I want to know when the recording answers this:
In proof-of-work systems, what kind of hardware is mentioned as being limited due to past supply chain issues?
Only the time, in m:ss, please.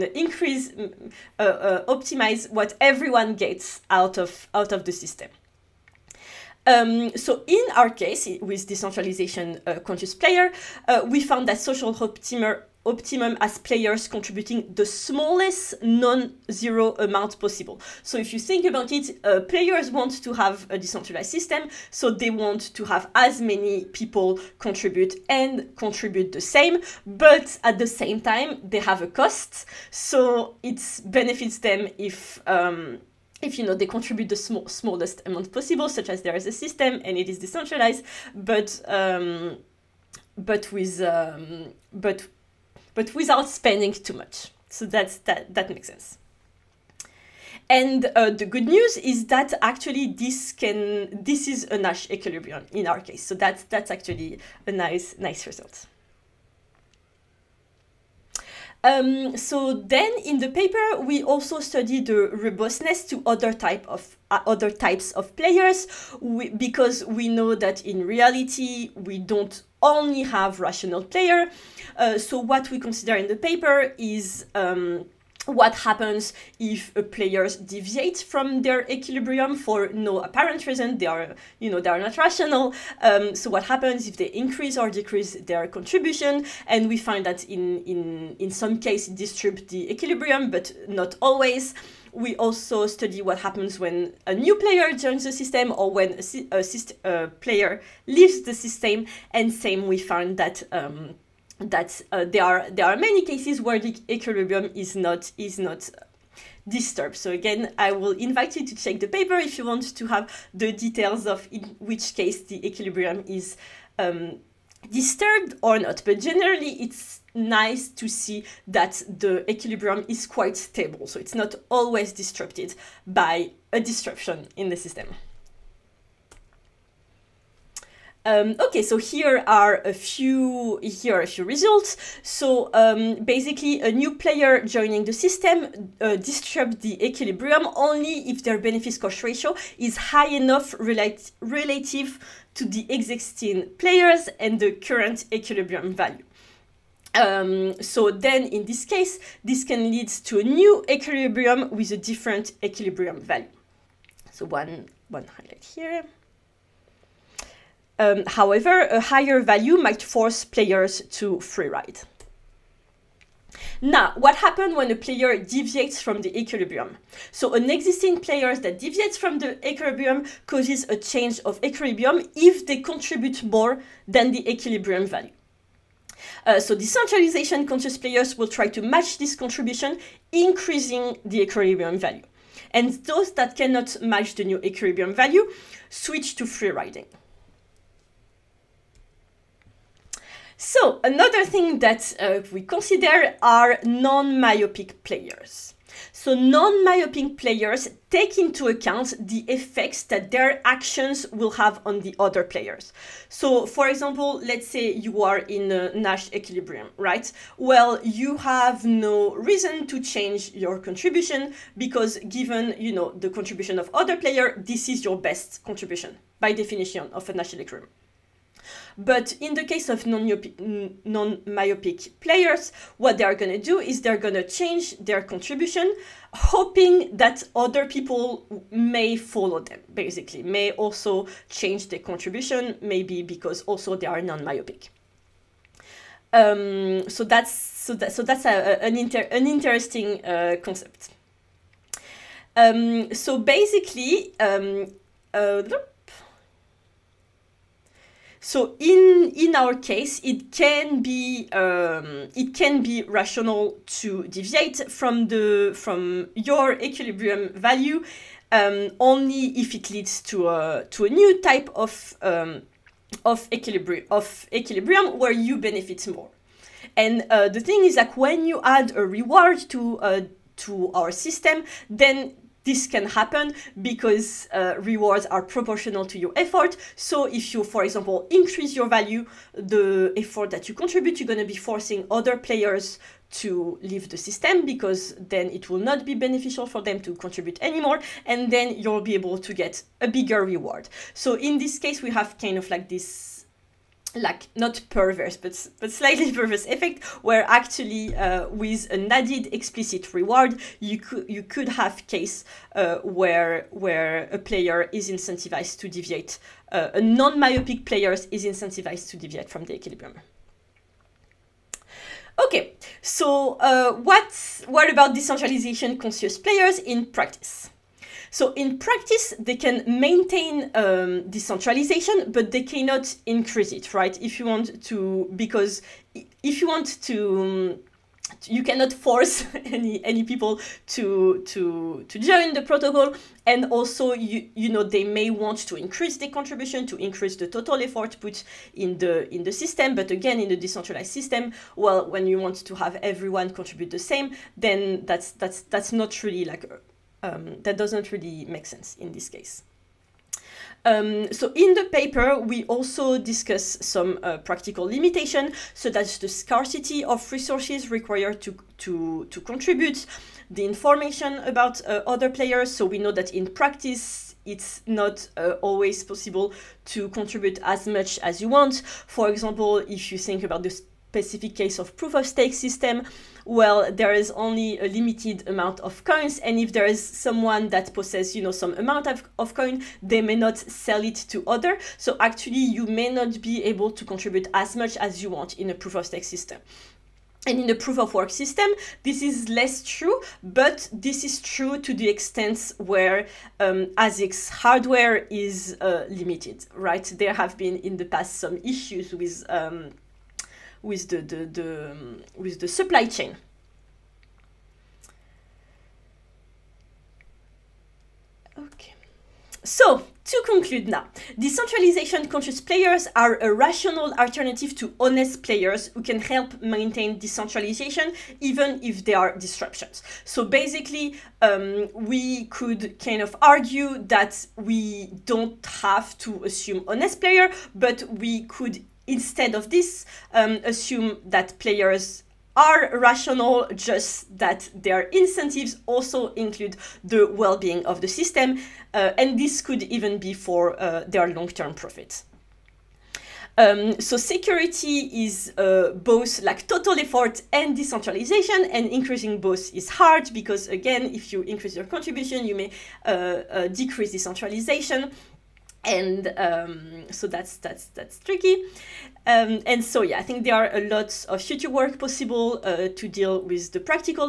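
6:33.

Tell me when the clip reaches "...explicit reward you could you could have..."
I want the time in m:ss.
4:59.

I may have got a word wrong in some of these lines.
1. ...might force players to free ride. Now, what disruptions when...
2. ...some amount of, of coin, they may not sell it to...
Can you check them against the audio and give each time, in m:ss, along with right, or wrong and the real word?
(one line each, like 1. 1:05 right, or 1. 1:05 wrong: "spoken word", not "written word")
1. 2:39 wrong: "happens", not "disruptions"
2. 6:18 right.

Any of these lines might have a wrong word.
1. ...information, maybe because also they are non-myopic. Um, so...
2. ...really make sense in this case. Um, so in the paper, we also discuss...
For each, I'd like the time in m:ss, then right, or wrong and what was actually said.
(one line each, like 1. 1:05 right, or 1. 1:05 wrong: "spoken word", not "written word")
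1. 3:51 wrong: "contribution", not "information"
2. 5:48 right.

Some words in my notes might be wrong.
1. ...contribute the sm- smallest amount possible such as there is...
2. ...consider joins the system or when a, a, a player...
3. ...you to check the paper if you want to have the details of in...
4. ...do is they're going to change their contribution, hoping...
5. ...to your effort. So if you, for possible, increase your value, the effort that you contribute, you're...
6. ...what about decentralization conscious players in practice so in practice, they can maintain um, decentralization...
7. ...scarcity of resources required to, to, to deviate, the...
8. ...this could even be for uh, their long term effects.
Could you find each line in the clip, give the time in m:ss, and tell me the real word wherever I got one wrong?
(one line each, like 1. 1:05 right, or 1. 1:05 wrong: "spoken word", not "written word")
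1. 0:33 right
2. 1:34 wrong: "player", not "consider"
3. 1:48 right
4. 3:43 right
5. 4:36 wrong: "example", not "possible"
6. 5:14 right
7. 5:56 wrong: "contribute", not "deviate"
8. 7:19 wrong: "profits", not "effects".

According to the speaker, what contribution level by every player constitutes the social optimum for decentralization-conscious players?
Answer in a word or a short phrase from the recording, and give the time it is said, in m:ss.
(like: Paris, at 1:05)
Smallest non-zero amount, at 0:14.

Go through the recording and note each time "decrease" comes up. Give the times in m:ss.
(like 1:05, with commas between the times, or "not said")
1:24, 7:33.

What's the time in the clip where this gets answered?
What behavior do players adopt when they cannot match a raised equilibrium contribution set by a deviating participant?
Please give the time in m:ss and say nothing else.
3:06.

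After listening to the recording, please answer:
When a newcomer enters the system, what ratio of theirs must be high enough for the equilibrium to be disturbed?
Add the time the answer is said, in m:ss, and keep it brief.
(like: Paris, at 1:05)
Benefits cost ratio, at 2:18.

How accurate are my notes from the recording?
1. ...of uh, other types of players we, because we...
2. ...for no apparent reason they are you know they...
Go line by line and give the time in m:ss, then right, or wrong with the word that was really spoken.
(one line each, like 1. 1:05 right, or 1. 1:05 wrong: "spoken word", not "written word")
1. 1:03 right
2. 1:19 right.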